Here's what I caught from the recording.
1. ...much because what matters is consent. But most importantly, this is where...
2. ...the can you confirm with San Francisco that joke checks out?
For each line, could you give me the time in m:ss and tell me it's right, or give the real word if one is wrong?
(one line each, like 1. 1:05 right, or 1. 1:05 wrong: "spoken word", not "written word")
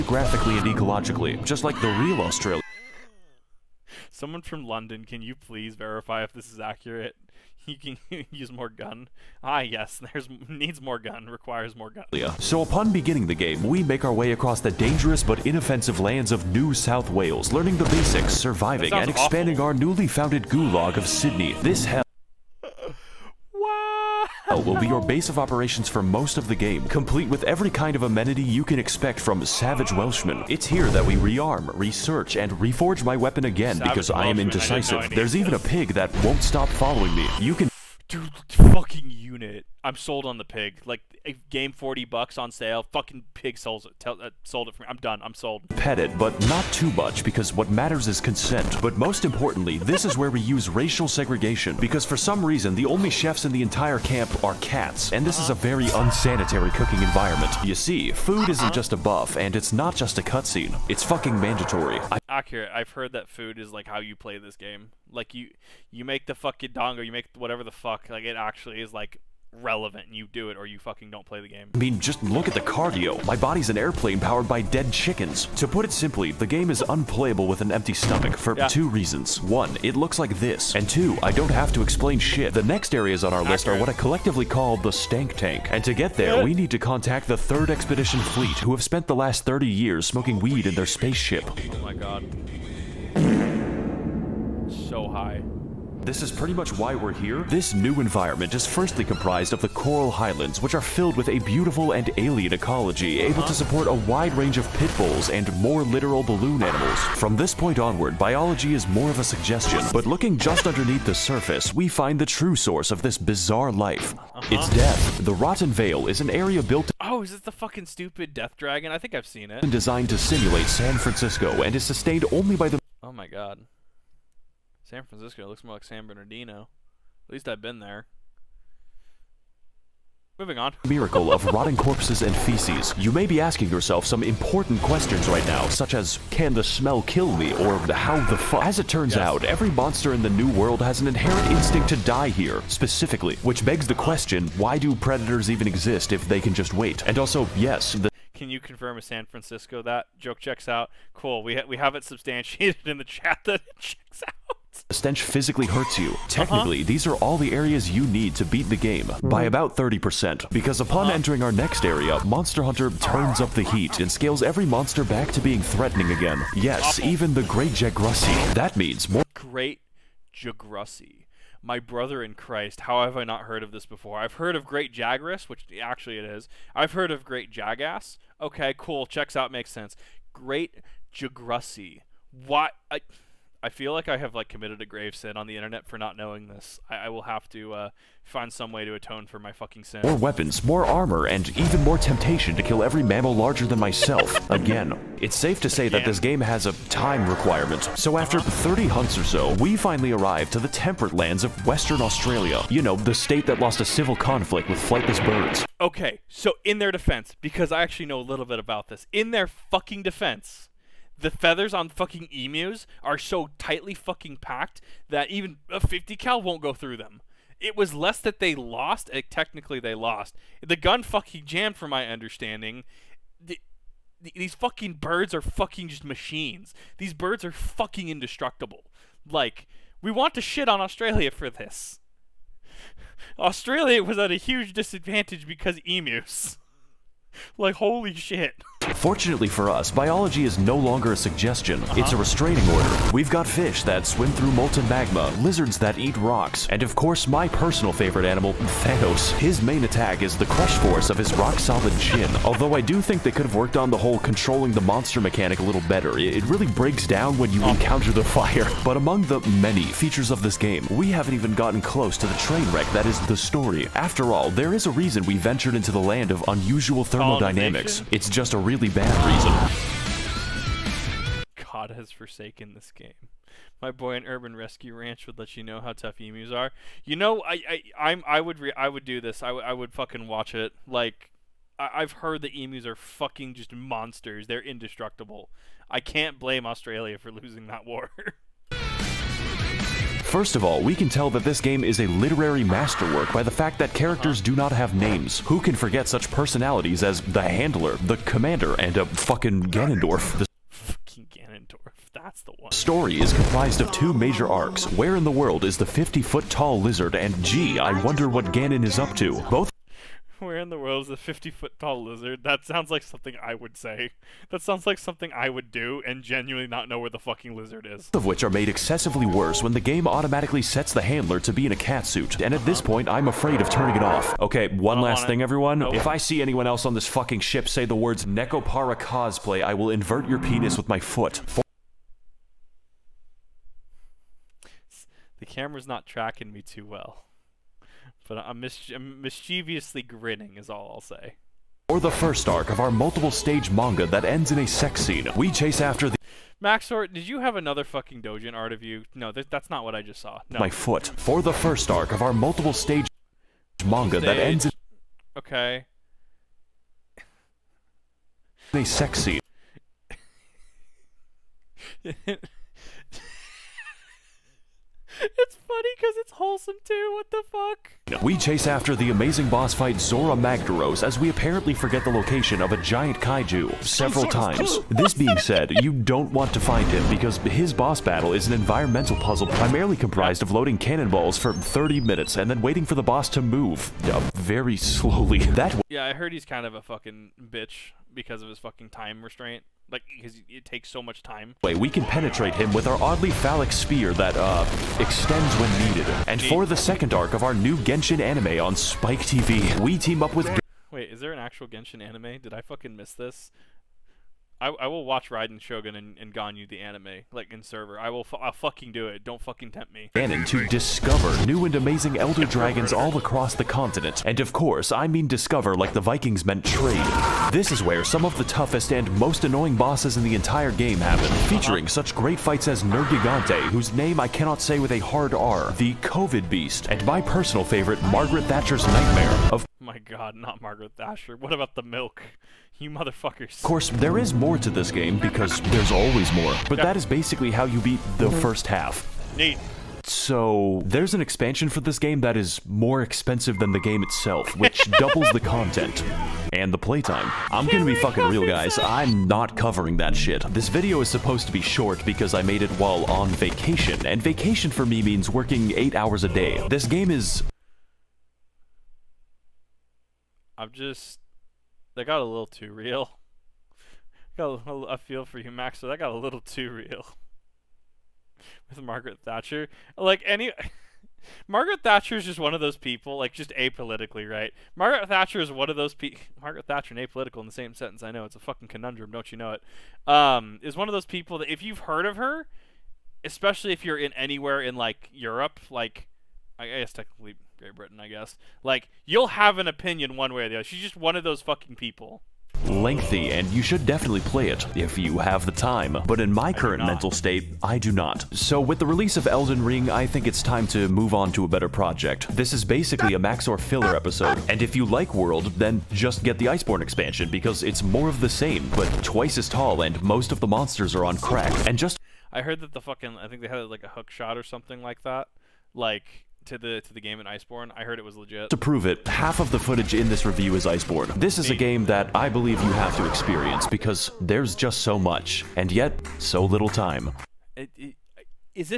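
1. 0:46 right
2. 2:27 right.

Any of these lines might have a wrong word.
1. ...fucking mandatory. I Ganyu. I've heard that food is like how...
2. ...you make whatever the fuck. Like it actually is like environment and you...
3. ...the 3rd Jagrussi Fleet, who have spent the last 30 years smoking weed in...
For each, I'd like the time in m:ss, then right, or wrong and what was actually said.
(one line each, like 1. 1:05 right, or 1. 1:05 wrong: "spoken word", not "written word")
1. 1:01 wrong: "Accurate", not "Ganyu"
2. 1:07 wrong: "relevant", not "environment"
3. 1:27 wrong: "Expedition", not "Jagrussi".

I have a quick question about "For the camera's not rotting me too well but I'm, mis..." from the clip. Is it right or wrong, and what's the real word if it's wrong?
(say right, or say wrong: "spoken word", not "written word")
wrong: "tracking", not "rotting".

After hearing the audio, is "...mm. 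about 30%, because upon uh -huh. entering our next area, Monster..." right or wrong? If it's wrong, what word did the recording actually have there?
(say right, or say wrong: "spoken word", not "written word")
right.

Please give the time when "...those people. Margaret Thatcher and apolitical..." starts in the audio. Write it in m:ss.
7:55.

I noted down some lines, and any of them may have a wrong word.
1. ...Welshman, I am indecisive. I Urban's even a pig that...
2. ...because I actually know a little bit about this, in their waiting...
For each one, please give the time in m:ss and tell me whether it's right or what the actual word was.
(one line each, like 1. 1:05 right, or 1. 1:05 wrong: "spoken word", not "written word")
1. 0:34 wrong: "There", not "Urban"
2. 3:27 wrong: "fucking", not "waiting".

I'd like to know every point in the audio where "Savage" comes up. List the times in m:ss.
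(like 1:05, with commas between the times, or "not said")
0:29, 0:33.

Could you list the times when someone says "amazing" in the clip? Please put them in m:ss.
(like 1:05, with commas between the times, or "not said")
6:09, 6:51.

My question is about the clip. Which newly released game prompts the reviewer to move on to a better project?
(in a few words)
Elden Ring.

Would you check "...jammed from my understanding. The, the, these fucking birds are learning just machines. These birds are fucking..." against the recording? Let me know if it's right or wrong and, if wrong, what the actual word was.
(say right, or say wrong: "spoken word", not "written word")
wrong: "fucking", not "learning".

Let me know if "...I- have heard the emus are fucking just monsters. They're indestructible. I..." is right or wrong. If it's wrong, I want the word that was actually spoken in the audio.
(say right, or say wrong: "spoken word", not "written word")
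right.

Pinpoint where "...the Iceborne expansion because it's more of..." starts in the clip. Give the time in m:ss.
8:26.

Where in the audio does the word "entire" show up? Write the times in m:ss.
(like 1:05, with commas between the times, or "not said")
0:53, 7:00.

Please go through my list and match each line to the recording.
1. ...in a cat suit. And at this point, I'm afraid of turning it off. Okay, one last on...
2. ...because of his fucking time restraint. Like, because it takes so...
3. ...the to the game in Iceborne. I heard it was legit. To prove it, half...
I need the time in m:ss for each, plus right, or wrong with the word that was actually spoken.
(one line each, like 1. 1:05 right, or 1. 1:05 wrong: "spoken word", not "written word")
1. 5:21 right
2. 6:28 right
3. 8:36 right.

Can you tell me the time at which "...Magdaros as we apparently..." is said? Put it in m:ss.
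6:10.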